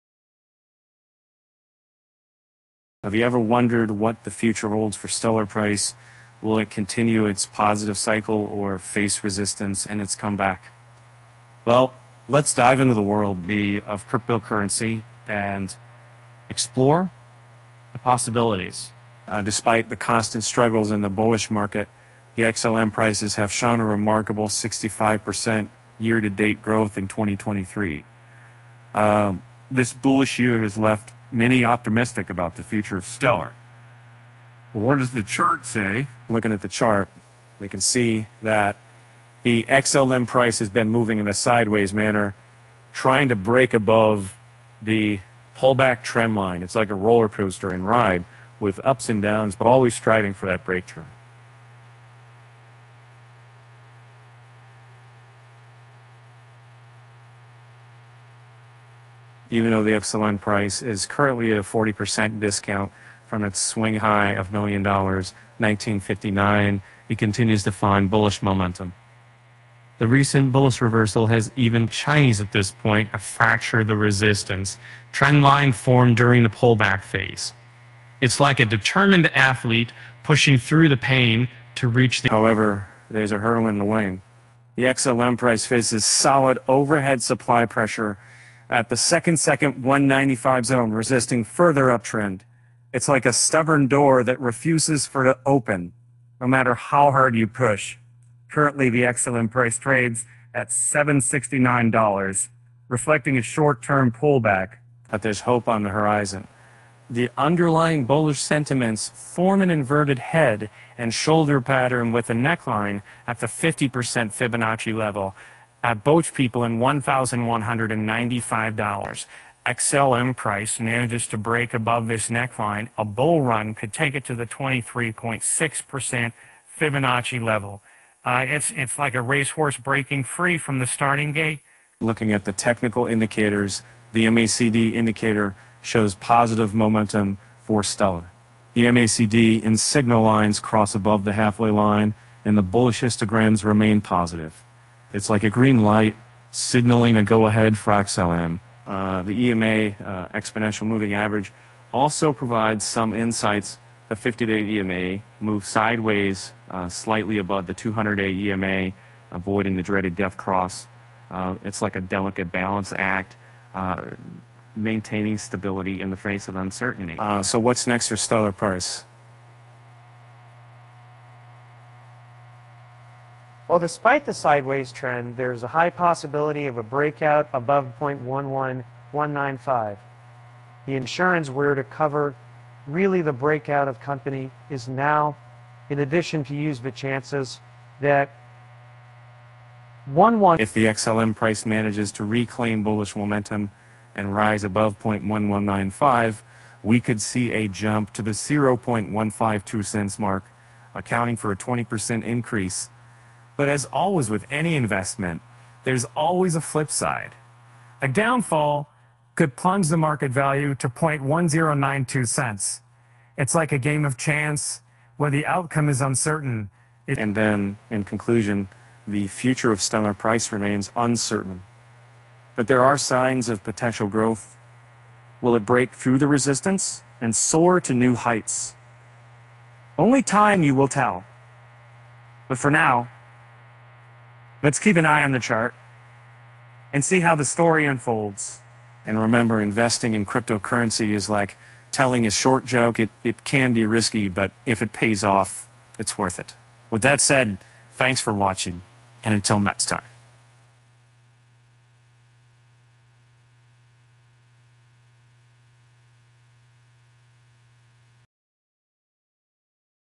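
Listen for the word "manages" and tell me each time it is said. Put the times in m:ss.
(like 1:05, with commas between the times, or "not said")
2:00, 3:11.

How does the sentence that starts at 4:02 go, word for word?
It, it can be risky, but if it pays off, it's worth it.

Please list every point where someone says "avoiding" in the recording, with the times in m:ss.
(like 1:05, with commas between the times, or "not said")
2:39.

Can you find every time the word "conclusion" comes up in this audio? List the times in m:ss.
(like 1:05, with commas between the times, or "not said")
3:38.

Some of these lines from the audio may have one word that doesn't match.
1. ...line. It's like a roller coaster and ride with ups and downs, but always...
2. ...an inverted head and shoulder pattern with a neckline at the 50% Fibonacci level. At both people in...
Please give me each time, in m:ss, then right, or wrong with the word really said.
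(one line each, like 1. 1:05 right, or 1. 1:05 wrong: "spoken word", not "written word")
1. 0:46 right
2. 1:49 right.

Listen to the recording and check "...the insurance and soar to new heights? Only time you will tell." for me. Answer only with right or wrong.
wrong.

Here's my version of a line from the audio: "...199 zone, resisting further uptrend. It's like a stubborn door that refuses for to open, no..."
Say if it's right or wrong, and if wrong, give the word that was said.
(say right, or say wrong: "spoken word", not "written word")
wrong: "195", not "199".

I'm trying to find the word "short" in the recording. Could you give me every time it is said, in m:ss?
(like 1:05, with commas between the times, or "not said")
1:43, 4:02.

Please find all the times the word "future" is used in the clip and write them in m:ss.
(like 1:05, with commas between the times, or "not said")
0:04, 0:32, 3:39.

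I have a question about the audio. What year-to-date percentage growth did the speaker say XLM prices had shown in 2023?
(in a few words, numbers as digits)
65%.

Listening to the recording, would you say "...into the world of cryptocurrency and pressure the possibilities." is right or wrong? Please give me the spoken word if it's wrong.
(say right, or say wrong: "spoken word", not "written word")
wrong: "explore", not "pressure".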